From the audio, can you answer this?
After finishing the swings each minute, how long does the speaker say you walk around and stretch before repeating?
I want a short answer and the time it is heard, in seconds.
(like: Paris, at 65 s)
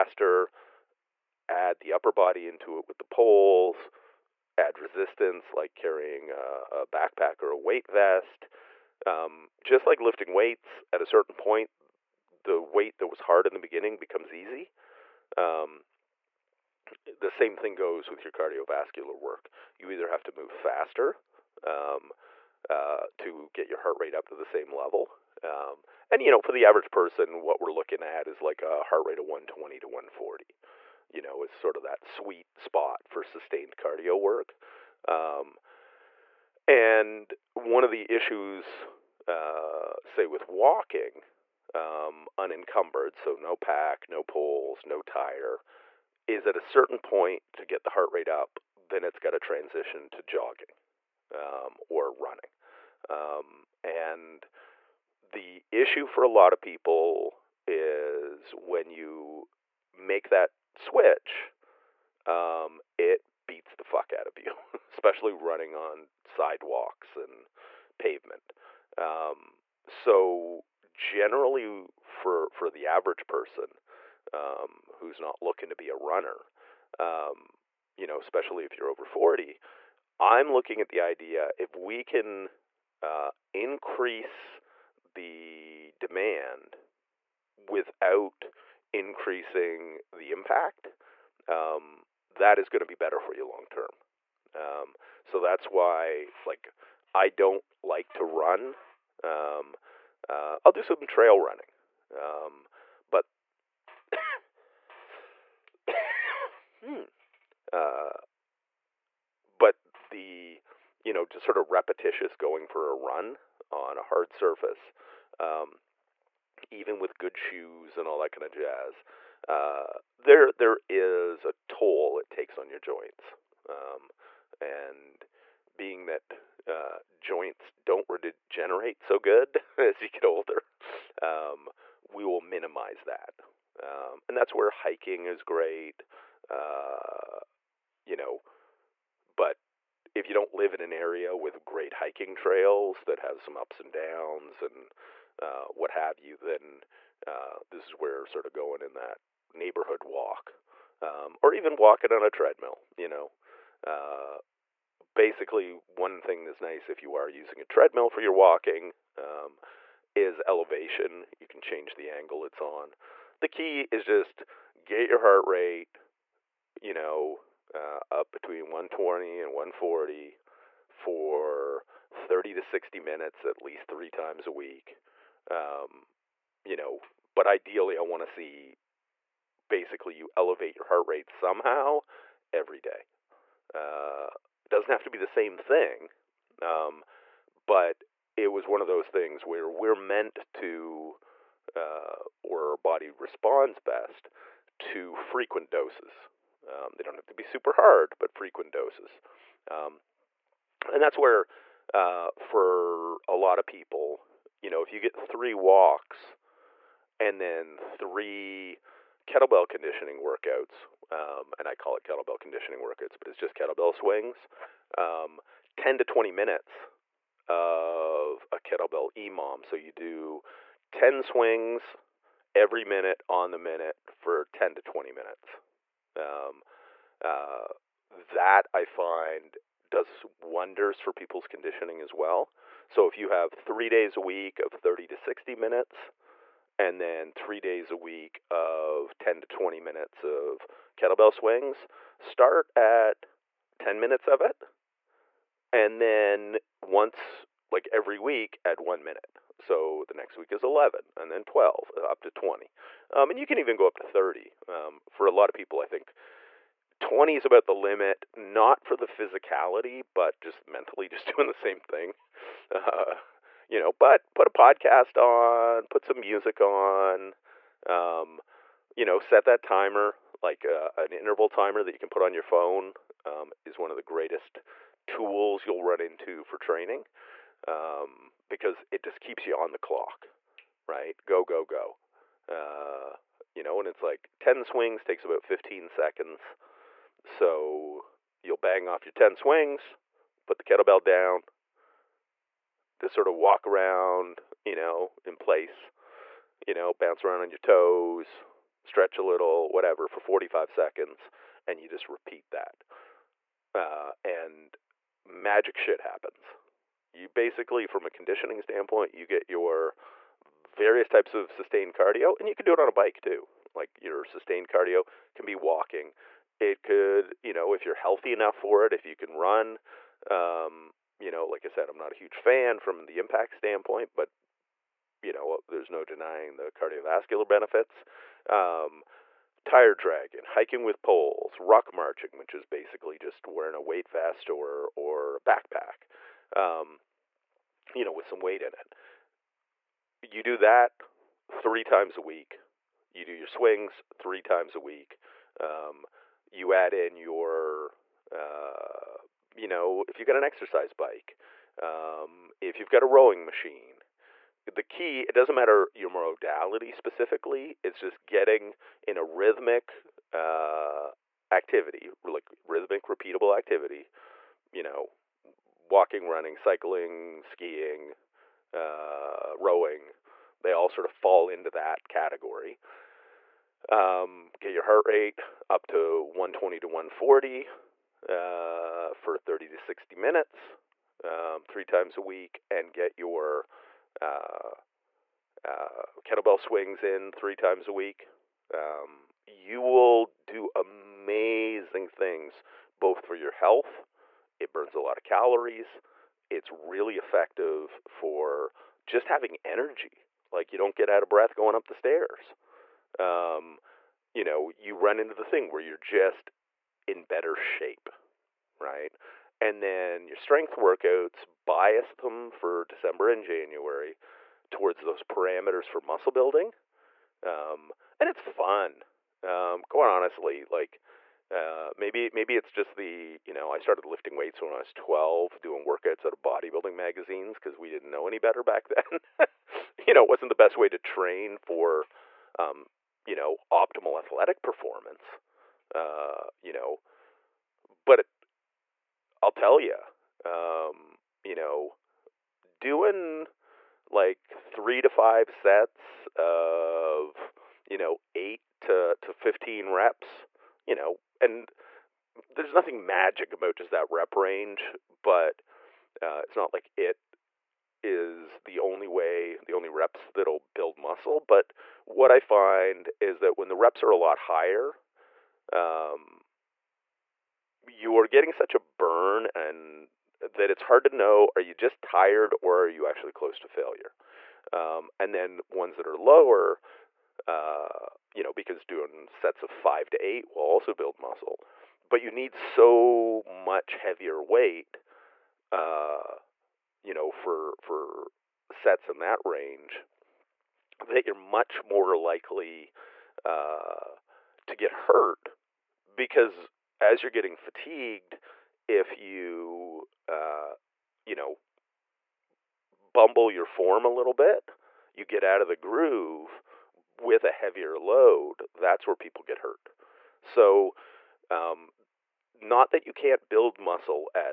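45 seconds, at 300 s.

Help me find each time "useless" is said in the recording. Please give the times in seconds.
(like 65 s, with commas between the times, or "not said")
not said.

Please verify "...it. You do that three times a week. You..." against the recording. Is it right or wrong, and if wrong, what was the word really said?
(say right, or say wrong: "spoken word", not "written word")
right.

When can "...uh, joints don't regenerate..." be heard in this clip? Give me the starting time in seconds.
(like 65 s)
126 s.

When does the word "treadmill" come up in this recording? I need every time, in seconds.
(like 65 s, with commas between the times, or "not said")
152 s, 157 s.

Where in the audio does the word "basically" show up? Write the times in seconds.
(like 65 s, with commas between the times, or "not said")
155 s, 179 s, 307 s, 332 s.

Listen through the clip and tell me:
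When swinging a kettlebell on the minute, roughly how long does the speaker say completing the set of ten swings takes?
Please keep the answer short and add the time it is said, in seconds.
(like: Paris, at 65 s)
15 seconds, at 285 s.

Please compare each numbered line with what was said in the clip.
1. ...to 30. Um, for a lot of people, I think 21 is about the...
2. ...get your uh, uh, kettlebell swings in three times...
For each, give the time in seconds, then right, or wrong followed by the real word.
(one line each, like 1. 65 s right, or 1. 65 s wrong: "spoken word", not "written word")
1. 253 s wrong: "20", not "21"
2. 382 s right.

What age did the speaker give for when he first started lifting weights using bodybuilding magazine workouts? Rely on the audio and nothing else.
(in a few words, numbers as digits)
12.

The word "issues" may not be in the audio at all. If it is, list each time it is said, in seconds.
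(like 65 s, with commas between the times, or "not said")
38 s, 55 s.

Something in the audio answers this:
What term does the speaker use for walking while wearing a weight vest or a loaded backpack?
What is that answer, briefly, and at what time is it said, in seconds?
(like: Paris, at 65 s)
ruck marching, at 331 s.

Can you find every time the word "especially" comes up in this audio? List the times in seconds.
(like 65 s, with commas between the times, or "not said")
64 s, 78 s.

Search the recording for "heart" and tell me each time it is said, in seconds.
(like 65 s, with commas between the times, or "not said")
23 s, 28 s, 47 s, 165 s, 180 s, 374 s.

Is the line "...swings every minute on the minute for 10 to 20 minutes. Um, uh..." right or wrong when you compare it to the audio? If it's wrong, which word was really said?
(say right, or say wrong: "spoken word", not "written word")
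right.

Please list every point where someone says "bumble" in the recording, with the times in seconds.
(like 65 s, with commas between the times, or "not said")
502 s.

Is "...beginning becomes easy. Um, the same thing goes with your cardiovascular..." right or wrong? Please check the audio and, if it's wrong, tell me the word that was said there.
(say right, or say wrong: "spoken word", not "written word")
right.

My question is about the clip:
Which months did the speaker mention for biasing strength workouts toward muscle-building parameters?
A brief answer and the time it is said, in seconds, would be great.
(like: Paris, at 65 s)
December and January, at 412 s.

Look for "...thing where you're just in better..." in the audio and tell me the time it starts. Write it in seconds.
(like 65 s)
405 s.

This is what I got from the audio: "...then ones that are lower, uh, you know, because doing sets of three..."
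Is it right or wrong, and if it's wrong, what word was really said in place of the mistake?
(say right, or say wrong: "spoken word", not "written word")
wrong: "five", not "three".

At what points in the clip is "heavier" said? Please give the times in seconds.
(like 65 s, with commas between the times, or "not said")
483 s, 507 s.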